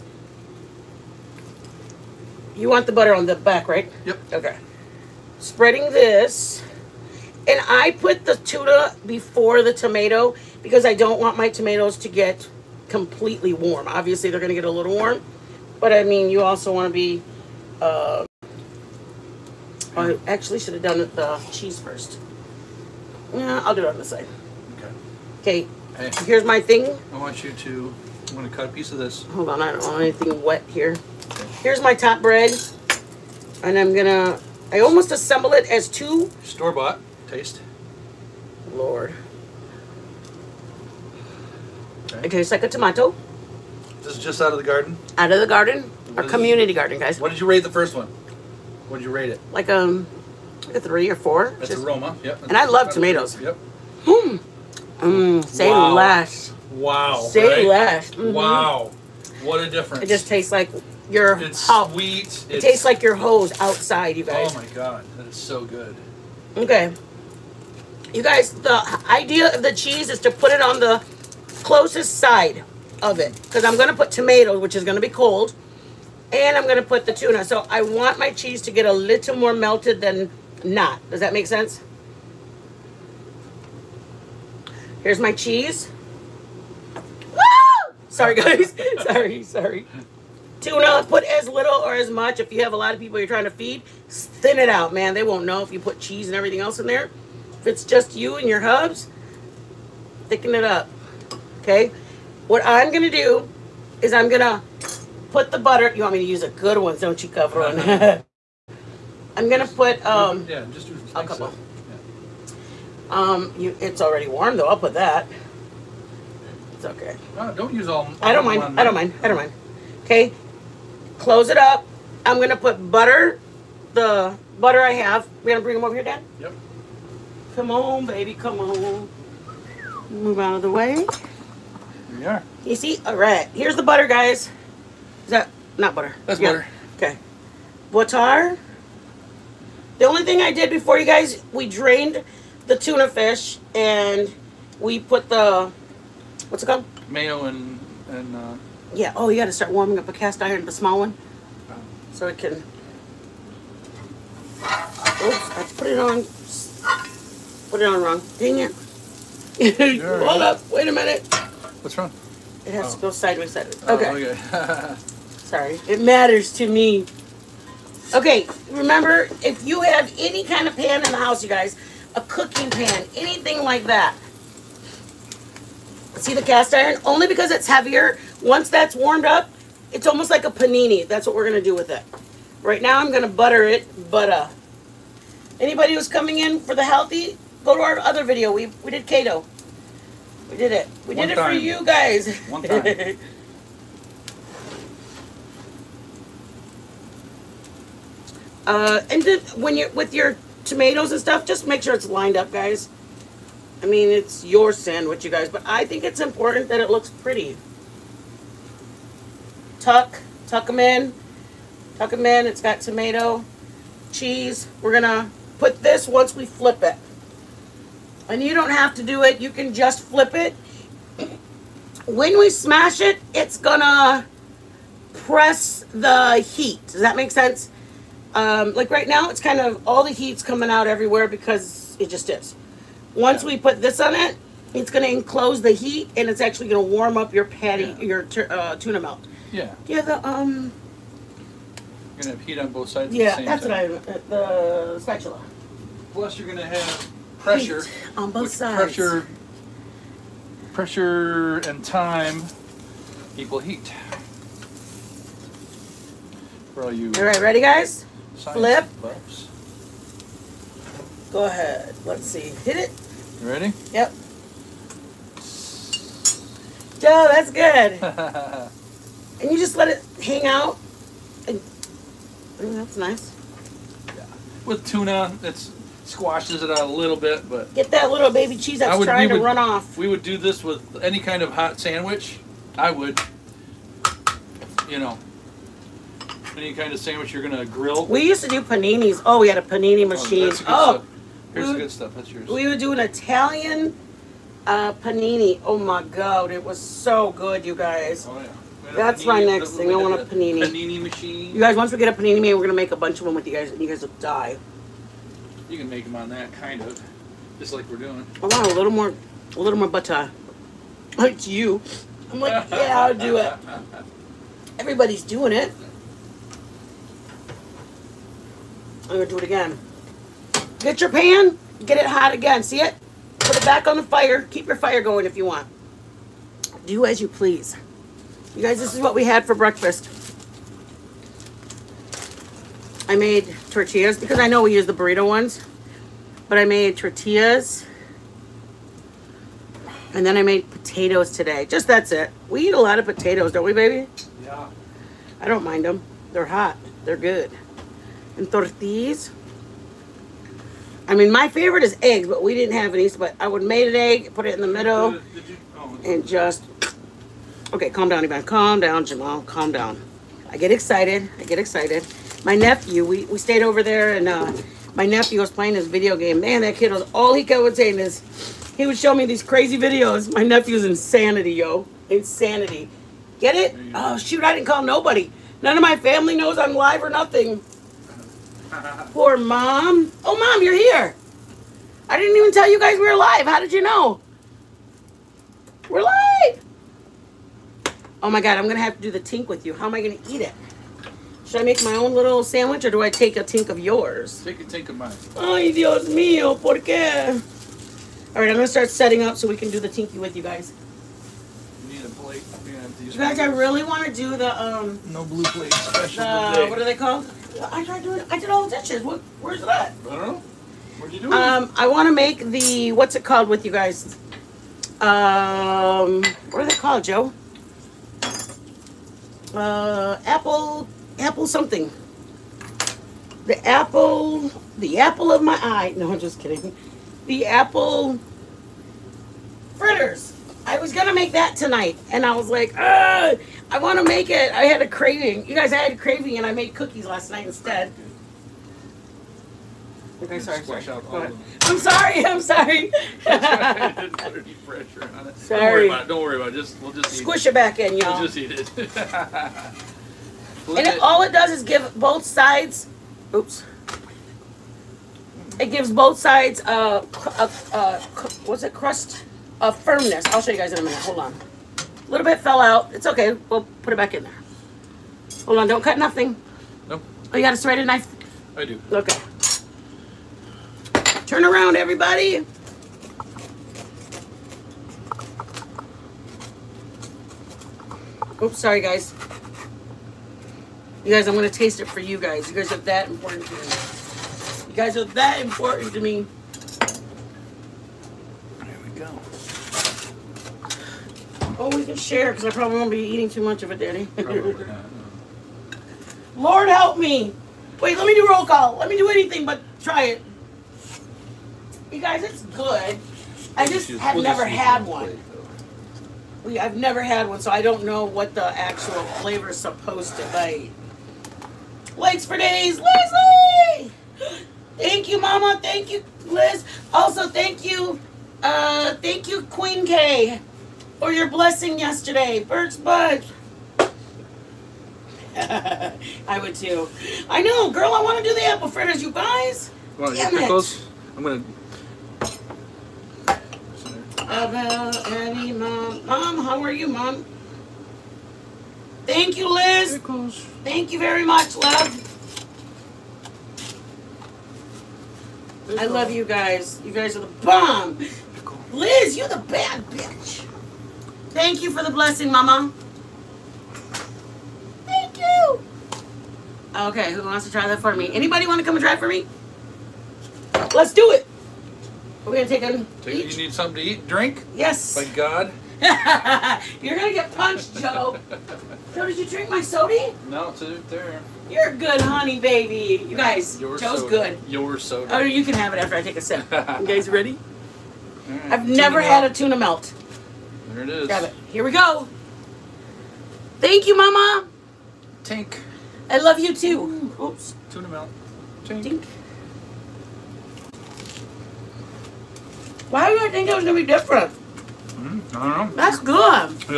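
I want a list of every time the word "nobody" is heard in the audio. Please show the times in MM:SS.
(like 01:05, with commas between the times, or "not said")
06:14.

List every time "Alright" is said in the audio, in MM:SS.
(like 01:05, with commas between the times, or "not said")
not said.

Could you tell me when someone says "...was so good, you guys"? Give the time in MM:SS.
04:56.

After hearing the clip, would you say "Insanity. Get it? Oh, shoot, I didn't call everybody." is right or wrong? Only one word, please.
wrong.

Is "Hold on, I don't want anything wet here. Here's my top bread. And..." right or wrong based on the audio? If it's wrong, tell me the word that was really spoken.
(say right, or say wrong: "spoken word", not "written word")
right.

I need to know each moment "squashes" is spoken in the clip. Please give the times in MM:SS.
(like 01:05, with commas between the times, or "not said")
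04:36.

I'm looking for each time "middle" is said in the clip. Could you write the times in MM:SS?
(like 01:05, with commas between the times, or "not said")
05:54.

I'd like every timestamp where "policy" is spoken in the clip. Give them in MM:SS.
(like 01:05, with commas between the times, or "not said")
not said.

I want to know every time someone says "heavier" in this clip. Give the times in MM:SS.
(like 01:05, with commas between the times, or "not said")
02:57.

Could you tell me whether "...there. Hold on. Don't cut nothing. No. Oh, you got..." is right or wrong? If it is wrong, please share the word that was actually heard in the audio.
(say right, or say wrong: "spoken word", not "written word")
right.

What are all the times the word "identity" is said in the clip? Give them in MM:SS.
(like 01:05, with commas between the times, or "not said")
not said.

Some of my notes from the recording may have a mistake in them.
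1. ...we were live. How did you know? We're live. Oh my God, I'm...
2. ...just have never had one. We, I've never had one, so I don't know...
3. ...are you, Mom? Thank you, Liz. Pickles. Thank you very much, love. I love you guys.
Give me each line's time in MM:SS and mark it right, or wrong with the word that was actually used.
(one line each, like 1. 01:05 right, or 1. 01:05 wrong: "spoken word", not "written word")
1. 06:22 right
2. 08:23 right
3. 08:56 right.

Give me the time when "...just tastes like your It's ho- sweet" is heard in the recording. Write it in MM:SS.
01:00.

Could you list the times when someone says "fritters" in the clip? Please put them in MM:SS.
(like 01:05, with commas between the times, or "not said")
07:09, 08:48.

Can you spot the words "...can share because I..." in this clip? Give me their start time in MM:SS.
08:11.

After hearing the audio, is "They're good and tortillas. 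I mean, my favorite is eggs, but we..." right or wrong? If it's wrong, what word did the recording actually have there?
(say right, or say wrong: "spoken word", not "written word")
right.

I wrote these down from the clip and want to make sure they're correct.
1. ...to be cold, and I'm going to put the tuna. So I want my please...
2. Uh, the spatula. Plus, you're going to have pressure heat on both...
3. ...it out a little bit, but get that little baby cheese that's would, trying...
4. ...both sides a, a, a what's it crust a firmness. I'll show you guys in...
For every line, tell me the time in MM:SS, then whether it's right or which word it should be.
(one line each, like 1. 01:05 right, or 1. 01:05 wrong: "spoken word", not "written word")
1. 01:14 wrong: "cheese", not "please"
2. 04:04 right
3. 04:36 right
4. 07:35 right.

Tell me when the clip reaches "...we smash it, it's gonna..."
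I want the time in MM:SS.
03:42.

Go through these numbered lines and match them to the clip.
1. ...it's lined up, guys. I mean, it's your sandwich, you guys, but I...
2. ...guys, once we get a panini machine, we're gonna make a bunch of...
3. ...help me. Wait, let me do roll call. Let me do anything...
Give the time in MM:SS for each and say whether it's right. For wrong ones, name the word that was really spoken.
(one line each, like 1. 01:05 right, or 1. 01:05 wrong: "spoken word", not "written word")
1. 03:21 right
2. 05:01 right
3. 08:16 right.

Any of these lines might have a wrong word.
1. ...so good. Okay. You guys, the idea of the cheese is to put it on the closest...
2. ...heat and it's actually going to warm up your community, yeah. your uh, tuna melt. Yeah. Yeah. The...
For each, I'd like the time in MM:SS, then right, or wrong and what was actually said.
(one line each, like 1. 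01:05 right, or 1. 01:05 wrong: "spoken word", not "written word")
1. 01:05 right
2. 03:55 wrong: "patty", not "community".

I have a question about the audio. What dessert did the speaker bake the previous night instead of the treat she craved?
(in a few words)
Cookies.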